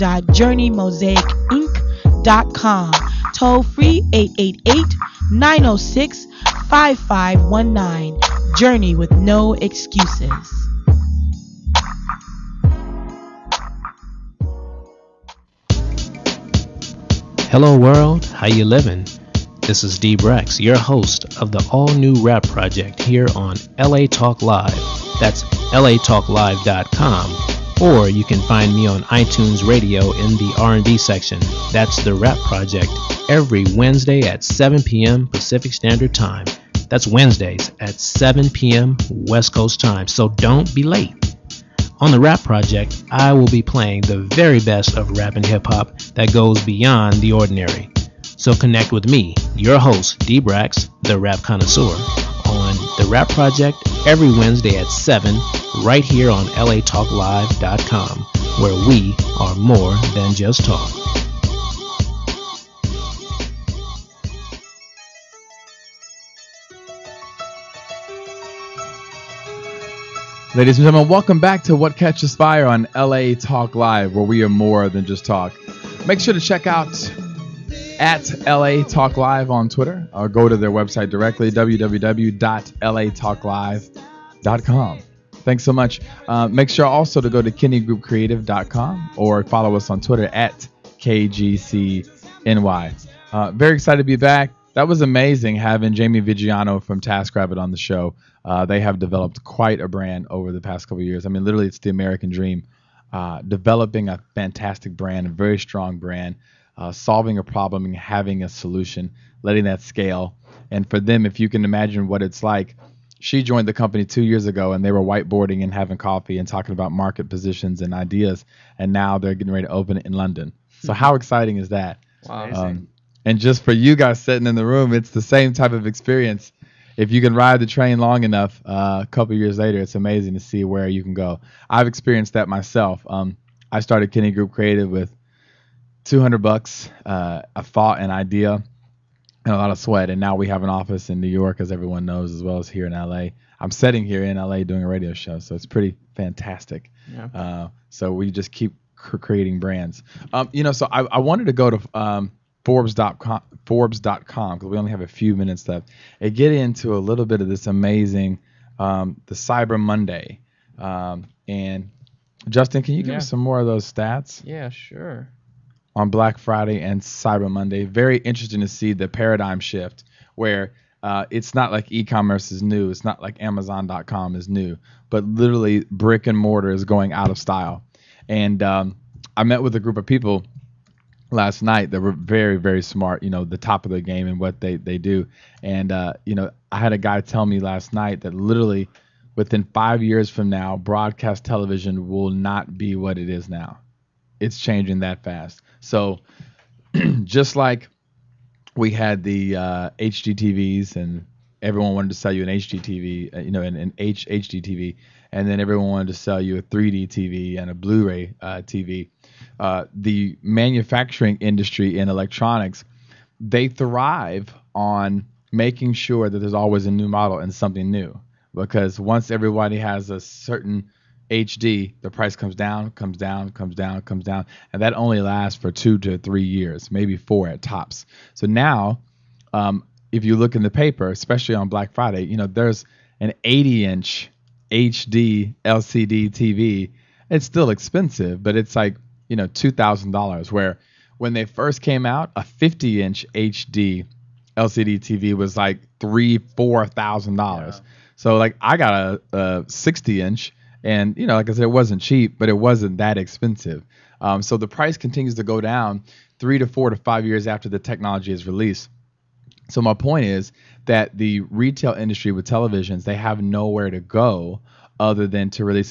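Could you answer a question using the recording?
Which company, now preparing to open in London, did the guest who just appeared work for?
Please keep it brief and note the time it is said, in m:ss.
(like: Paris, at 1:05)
TaskRabbit, at 1:37.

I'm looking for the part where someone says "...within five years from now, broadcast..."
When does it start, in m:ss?
3:09.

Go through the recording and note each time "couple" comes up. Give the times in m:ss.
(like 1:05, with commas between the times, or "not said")
1:40, 2:09.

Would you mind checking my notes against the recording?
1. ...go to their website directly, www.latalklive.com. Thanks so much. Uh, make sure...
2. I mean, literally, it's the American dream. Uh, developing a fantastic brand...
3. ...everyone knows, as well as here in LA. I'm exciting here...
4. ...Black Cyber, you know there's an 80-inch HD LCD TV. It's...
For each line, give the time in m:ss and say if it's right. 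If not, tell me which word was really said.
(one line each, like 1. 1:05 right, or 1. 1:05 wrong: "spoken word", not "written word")
1. 1:20 right
2. 1:41 right
3. 2:21 wrong: "sitting", not "exciting"
4. 3:51 wrong: "Friday", not "Cyber".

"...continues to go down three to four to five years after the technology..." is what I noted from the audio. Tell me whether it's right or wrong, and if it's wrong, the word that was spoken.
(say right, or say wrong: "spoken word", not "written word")
right.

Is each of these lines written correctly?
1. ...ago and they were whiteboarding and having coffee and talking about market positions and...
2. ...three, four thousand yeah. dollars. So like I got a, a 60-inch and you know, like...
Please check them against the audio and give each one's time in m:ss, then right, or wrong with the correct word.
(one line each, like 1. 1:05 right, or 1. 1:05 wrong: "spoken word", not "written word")
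1. 1:54 right
2. 4:05 right.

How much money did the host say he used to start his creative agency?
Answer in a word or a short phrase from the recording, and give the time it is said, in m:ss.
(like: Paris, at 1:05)
$200, at 2:16.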